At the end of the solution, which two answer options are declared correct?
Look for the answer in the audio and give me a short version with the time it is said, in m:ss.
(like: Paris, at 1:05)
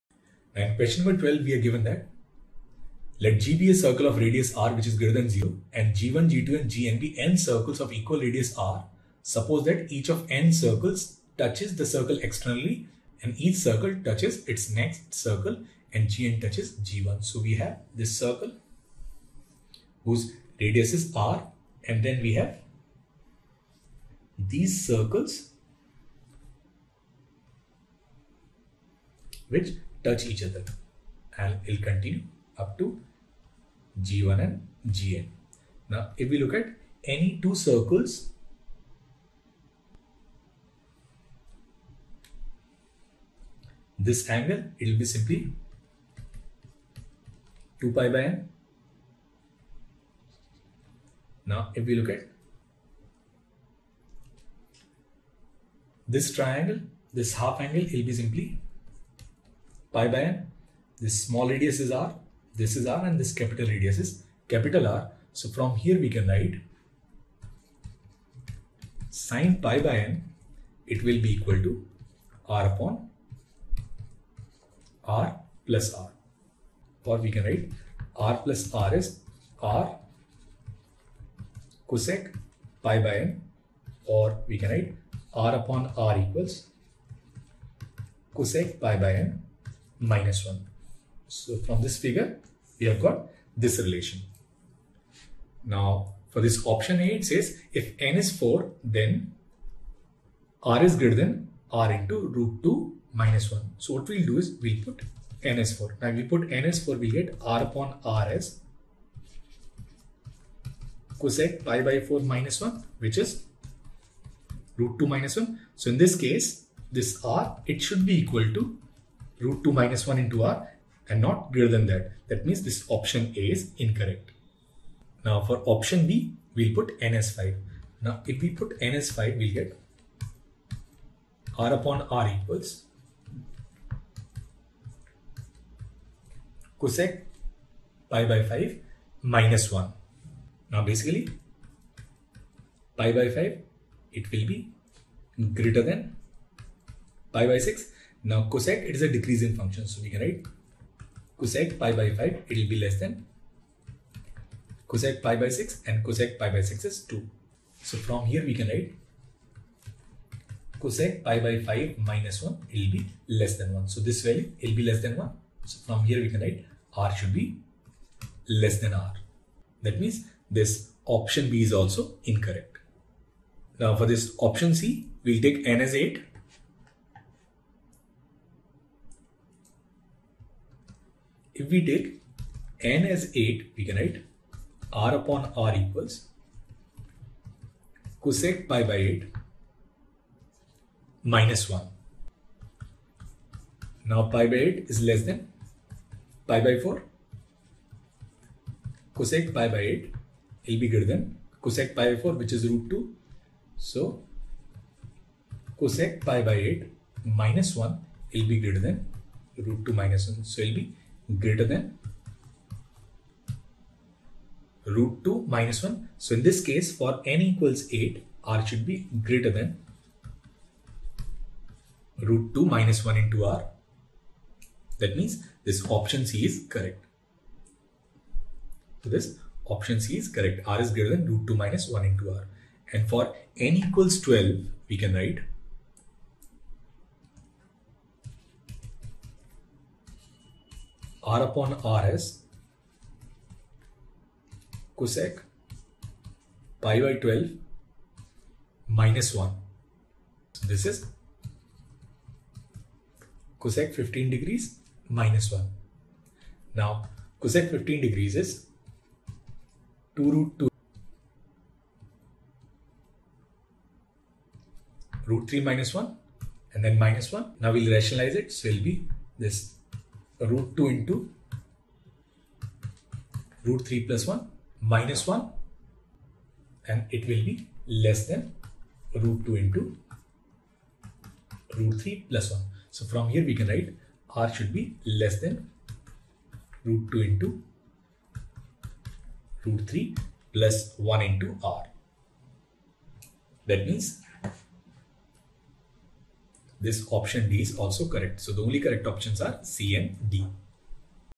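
C and D, at 4:59.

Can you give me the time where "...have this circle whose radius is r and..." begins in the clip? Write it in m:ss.
0:17.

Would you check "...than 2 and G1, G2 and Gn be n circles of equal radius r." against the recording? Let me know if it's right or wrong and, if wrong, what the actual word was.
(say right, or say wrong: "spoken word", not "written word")
wrong: "0", not "2".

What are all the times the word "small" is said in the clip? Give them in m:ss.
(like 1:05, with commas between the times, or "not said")
1:01.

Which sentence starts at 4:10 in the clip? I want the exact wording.
So this is cosec 15 degrees minus 1.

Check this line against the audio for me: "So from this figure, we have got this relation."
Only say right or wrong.
right.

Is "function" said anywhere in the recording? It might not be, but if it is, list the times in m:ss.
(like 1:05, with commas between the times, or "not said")
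2:29.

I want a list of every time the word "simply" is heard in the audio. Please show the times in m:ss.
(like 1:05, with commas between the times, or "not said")
0:45, 0:58.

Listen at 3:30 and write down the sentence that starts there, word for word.
So it will be greater than root 2 minus 1.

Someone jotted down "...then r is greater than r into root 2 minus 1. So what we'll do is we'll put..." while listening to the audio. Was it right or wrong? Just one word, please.
right.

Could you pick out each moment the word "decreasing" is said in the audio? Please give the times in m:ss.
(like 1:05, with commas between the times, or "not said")
2:29.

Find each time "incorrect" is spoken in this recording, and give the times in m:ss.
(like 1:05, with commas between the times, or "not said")
2:03, 2:52.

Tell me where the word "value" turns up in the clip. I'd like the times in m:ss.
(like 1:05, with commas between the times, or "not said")
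2:44.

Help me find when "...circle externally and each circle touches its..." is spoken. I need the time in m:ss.
0:11.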